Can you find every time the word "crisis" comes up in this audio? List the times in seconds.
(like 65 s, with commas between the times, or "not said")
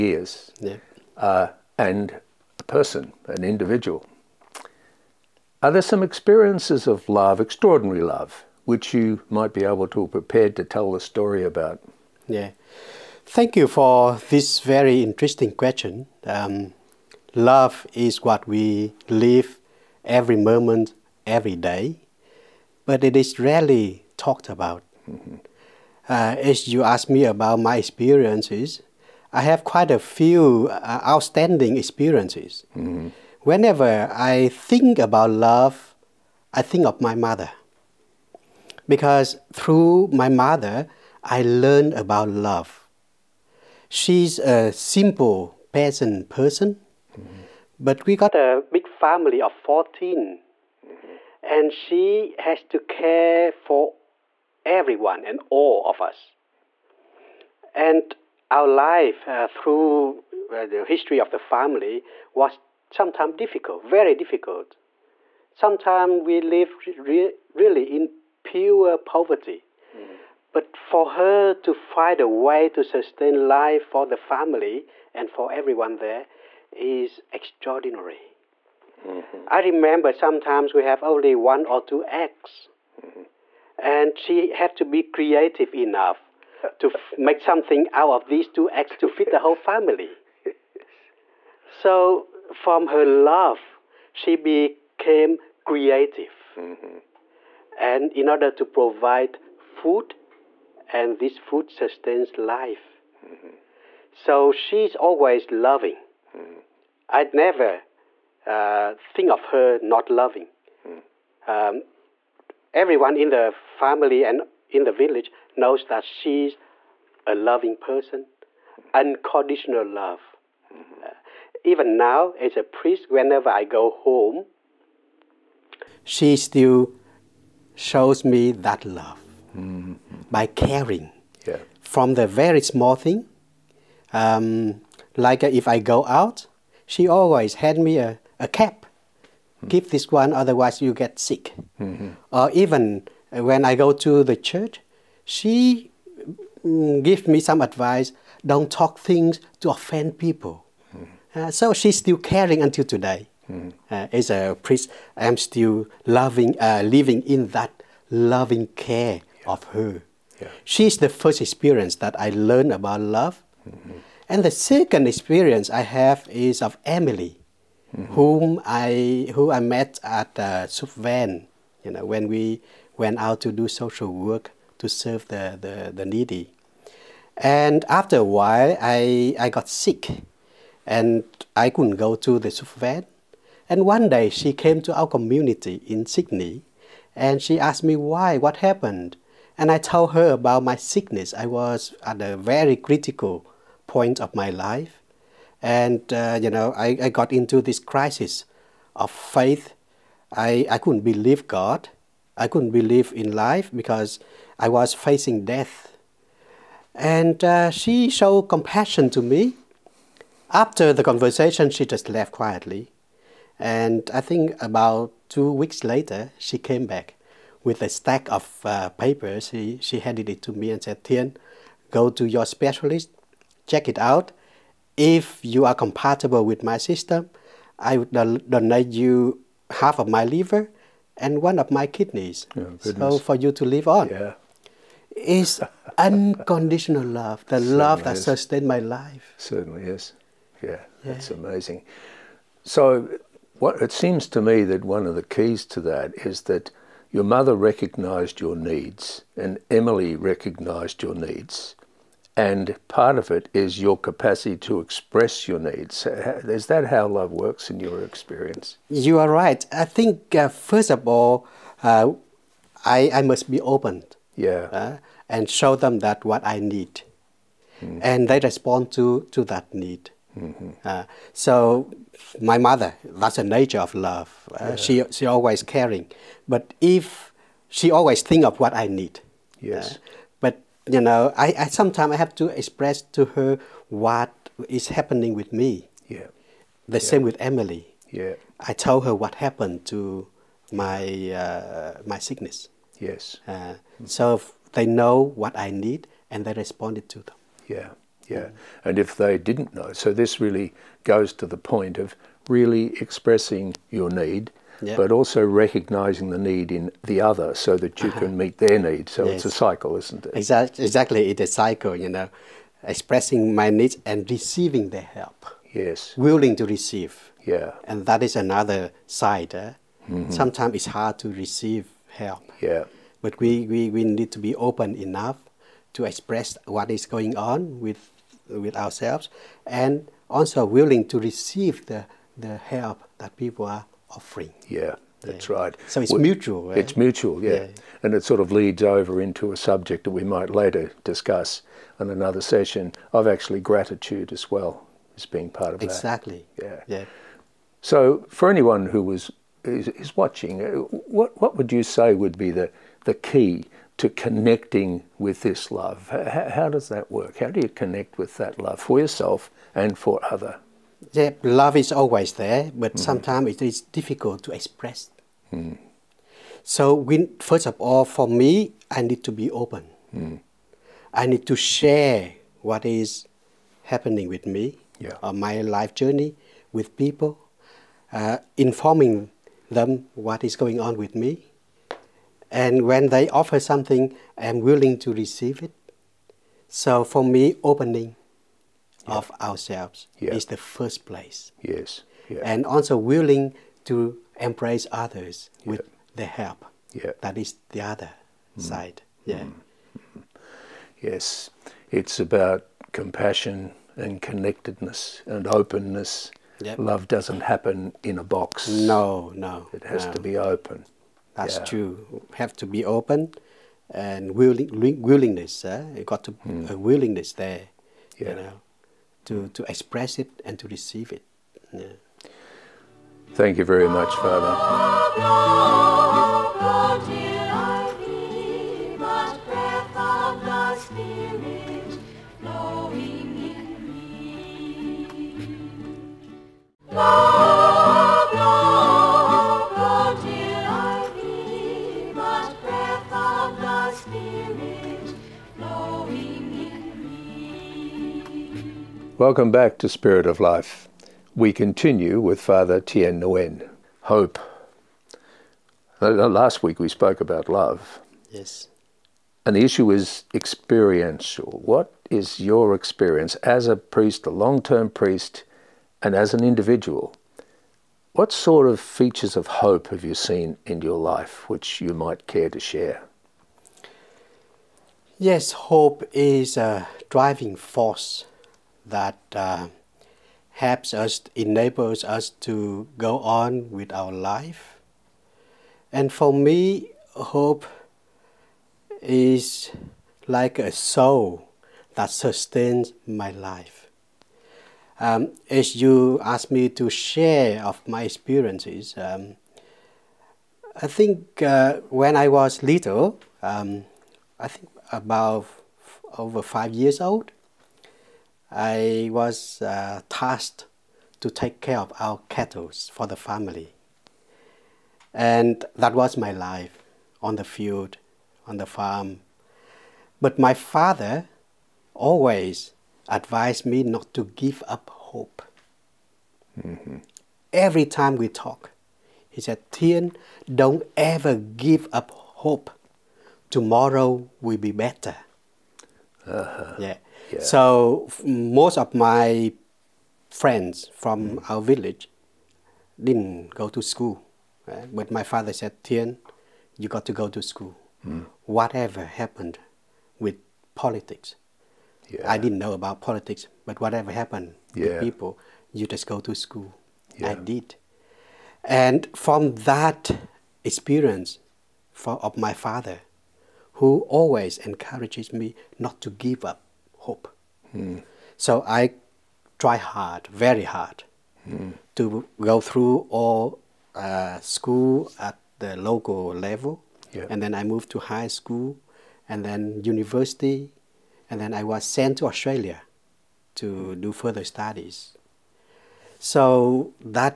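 197 s.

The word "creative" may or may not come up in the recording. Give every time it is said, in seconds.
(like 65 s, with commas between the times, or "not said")
85 s, 95 s.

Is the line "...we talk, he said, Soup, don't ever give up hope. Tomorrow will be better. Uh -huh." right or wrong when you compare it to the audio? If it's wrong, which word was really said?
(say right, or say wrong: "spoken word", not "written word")
wrong: "Thien", not "Soup".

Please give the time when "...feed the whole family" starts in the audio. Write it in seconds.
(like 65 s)
89 s.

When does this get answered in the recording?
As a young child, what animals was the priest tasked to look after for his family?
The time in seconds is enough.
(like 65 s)
512 s.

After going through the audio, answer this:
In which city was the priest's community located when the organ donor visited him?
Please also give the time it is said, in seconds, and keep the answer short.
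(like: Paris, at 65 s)
Sydney, at 186 s.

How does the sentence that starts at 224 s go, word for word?
If you are compatible with my system, I would donate you half of my liver and one of my kidneys.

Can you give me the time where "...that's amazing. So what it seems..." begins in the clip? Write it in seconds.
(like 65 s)
241 s.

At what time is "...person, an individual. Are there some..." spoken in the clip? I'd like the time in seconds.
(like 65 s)
2 s.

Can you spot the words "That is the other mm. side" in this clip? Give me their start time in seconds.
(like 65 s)
397 s.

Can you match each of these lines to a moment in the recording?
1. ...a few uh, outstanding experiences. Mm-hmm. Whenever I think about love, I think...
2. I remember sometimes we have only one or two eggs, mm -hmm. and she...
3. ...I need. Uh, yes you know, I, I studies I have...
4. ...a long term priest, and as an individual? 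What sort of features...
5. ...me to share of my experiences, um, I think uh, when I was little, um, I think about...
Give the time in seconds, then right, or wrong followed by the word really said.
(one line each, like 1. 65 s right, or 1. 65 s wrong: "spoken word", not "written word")
1. 29 s right
2. 79 s right
3. 278 s wrong: "sometimes", not "studies"
4. 464 s right
5. 496 s right.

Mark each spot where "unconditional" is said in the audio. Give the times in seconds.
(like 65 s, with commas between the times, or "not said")
118 s, 235 s.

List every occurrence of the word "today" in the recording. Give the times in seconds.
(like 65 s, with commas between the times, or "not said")
152 s.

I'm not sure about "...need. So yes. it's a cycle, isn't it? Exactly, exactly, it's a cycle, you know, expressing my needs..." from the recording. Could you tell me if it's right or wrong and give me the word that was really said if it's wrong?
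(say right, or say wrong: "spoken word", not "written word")
right.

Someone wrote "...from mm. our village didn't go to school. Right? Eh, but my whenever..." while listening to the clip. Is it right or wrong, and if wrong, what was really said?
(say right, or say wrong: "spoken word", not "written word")
wrong: "father", not "whenever".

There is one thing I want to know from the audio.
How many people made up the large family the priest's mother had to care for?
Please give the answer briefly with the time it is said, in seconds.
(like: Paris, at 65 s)
14, at 49 s.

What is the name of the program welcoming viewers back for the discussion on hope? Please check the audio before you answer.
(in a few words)
Spirit of Life.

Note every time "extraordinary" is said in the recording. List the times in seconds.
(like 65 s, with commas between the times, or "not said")
7 s, 77 s.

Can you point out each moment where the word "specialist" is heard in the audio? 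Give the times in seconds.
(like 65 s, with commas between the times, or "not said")
222 s.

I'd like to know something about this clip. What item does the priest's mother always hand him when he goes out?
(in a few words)
A cap.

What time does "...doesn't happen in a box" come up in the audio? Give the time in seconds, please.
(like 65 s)
407 s.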